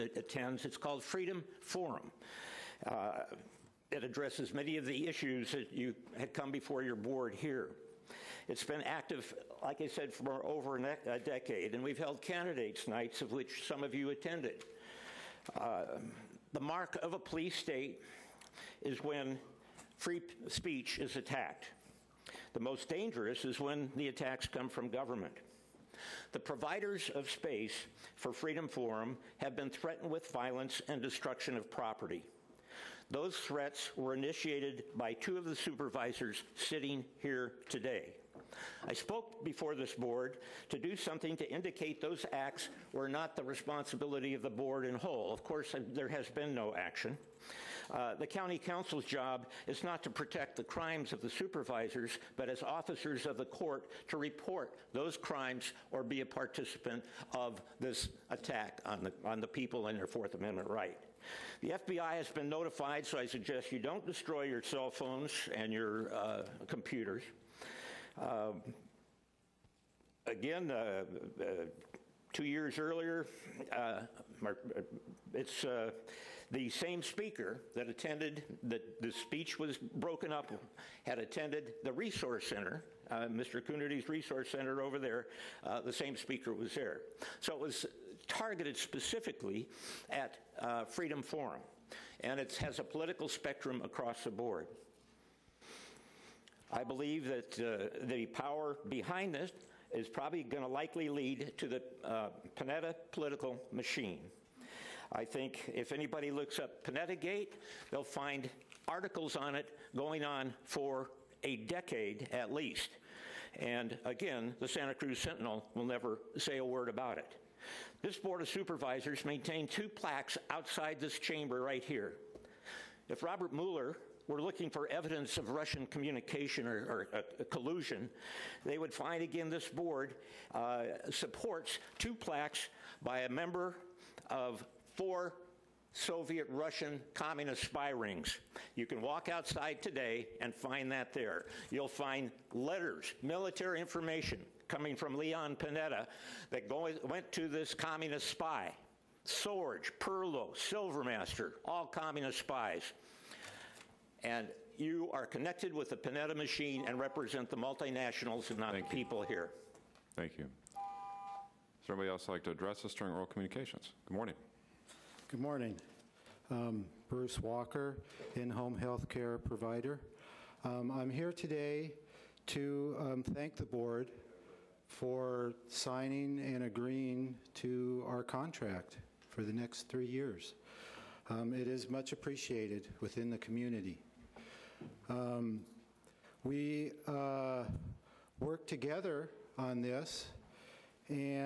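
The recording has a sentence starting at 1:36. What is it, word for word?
I believe that uh, the power behind this is probably going to likely lead to the uh, Panetta political machine.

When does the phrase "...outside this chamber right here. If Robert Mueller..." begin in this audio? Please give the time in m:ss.
2:00.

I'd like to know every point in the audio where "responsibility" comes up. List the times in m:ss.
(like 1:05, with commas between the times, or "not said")
0:43.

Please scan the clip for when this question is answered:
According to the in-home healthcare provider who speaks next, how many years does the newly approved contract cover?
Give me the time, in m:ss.
2:59.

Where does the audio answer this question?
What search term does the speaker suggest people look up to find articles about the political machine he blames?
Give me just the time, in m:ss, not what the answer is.
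1:46.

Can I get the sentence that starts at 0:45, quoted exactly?
Of course, there has been no action.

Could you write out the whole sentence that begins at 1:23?
Coonerty's Resource Center over there, uh, the same speaker was there.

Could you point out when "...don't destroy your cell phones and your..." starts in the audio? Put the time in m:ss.
1:03.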